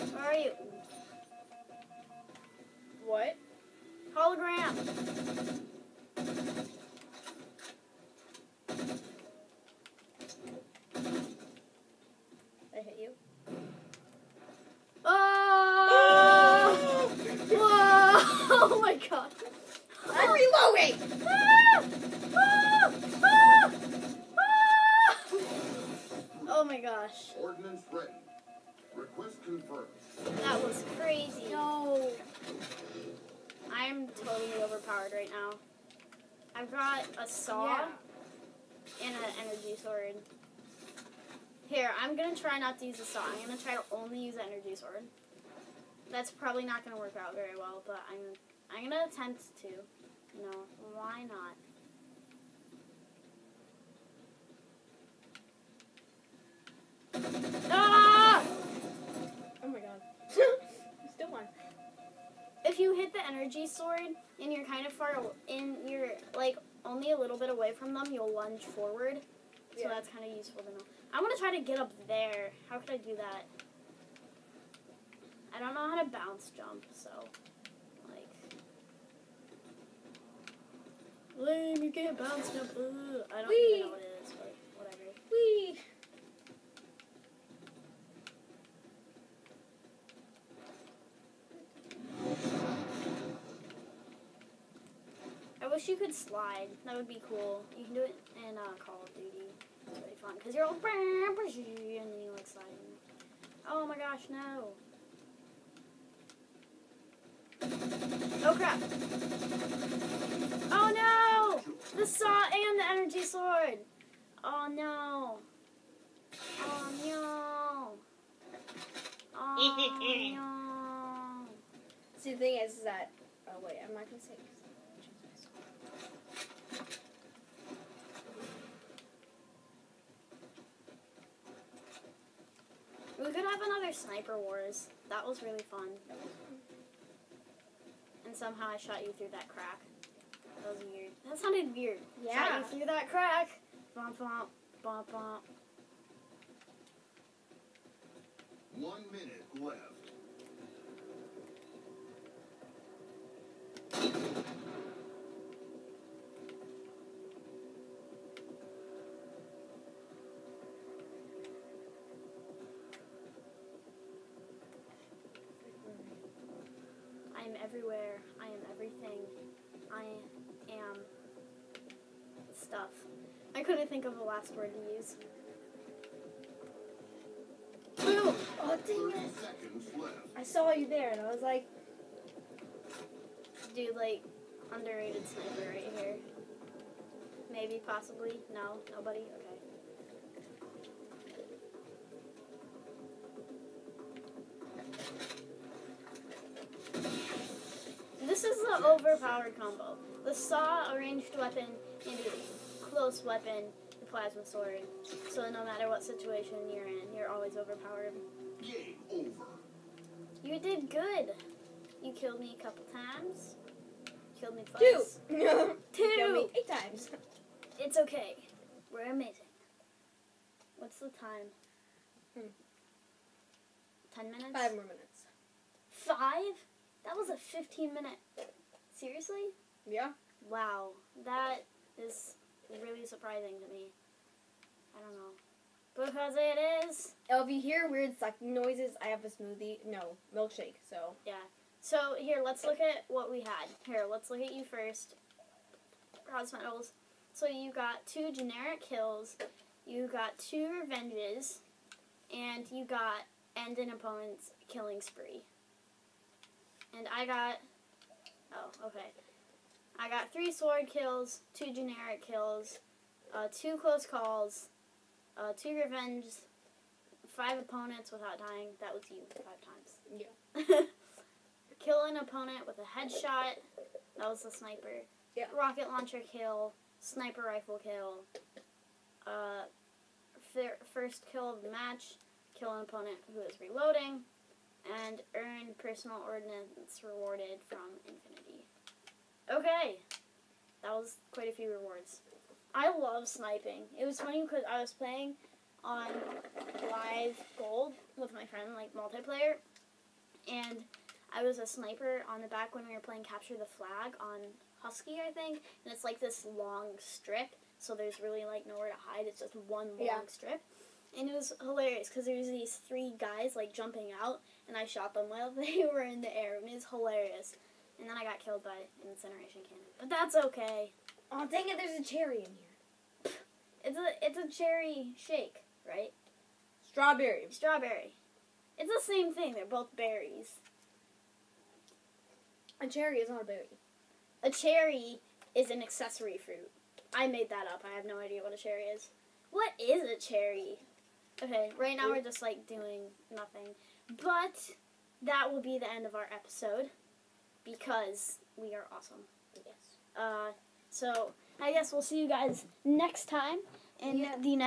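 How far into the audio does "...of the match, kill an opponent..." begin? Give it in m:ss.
4:41.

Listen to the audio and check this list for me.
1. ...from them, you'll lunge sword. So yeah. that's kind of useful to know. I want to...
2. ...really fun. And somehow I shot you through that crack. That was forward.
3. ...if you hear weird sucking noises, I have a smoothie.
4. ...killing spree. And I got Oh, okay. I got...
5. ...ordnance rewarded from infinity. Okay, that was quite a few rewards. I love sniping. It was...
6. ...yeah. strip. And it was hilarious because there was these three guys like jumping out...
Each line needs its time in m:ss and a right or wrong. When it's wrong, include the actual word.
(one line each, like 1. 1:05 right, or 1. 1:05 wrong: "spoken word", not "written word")
1. 1:07 wrong: "forward", not "sword"
2. 2:15 wrong: "weird", not "forward"
3. 3:57 right
4. 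4:14 right
5. 4:46 right
6. 5:10 right.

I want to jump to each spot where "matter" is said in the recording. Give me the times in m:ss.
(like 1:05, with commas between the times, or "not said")
3:25.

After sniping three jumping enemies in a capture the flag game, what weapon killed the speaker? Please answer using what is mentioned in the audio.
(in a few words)
incineration cannon.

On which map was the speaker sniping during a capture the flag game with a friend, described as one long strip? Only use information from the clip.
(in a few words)
Husky.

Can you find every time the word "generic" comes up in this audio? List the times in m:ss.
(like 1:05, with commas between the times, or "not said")
4:08, 4:21.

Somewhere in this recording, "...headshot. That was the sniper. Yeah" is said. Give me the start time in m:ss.
4:32.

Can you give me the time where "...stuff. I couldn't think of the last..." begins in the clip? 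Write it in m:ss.
2:52.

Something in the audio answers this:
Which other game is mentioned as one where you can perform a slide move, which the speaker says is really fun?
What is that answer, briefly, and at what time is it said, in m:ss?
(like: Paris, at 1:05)
Call of Duty, at 1:38.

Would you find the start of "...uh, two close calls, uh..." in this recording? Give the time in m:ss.
4:23.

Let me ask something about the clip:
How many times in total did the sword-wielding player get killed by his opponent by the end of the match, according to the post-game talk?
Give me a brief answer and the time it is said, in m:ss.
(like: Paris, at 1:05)
8, at 3:36.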